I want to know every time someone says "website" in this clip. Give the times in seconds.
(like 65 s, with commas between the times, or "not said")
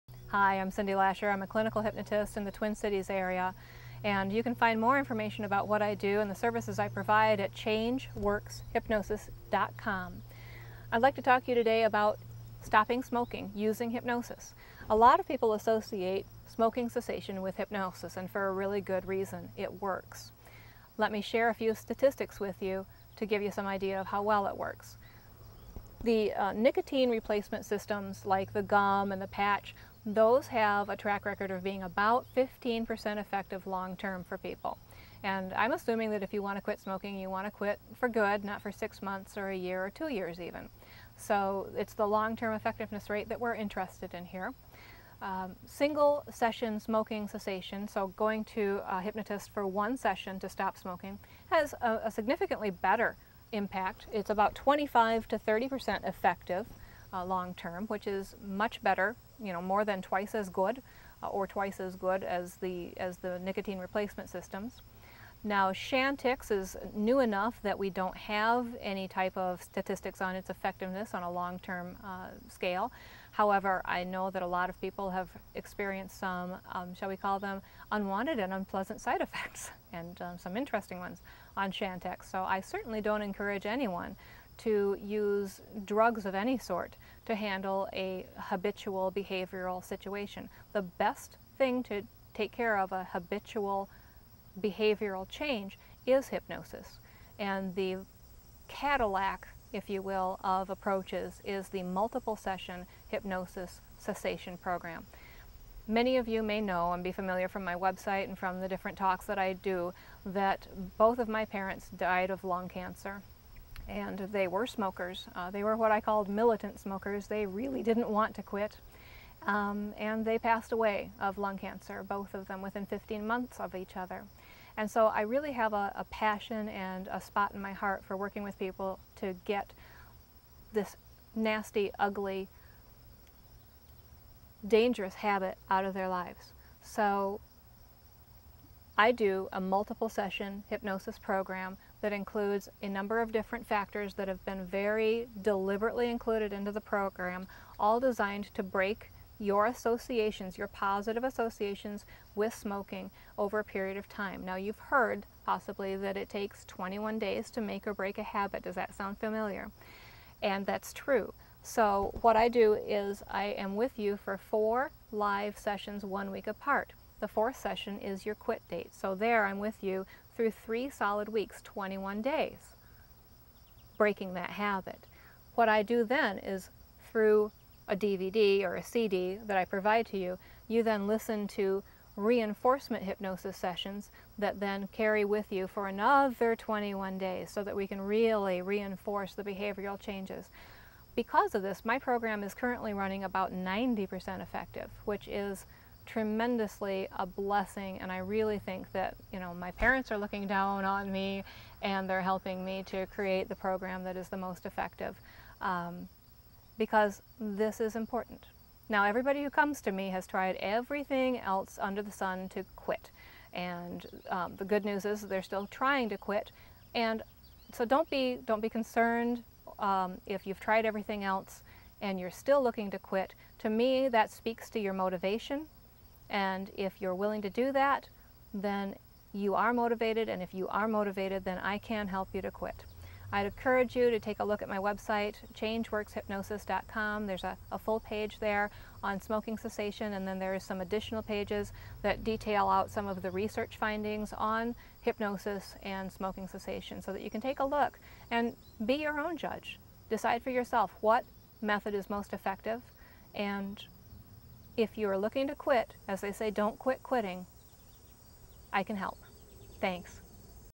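107 s, 234 s.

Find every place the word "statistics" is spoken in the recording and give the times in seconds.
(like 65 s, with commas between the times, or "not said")
21 s, 69 s.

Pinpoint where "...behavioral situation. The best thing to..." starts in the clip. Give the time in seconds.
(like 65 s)
89 s.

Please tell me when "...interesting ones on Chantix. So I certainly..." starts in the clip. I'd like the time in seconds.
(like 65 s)
80 s.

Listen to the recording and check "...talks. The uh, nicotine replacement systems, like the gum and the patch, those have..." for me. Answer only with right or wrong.
wrong.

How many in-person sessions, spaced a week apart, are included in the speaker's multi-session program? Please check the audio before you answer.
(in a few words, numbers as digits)
4.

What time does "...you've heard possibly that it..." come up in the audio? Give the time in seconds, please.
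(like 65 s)
154 s.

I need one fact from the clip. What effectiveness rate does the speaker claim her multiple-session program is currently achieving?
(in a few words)
90%.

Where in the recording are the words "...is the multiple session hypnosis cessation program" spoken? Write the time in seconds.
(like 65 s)
101 s.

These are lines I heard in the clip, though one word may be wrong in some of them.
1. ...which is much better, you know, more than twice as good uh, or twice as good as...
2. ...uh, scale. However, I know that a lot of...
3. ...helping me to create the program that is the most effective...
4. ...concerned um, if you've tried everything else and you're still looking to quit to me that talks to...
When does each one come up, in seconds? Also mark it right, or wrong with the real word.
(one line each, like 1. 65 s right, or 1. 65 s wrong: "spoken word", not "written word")
1. 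57 s right
2. 72 s right
3. 202 s right
4. 218 s wrong: "speaks", not "talks".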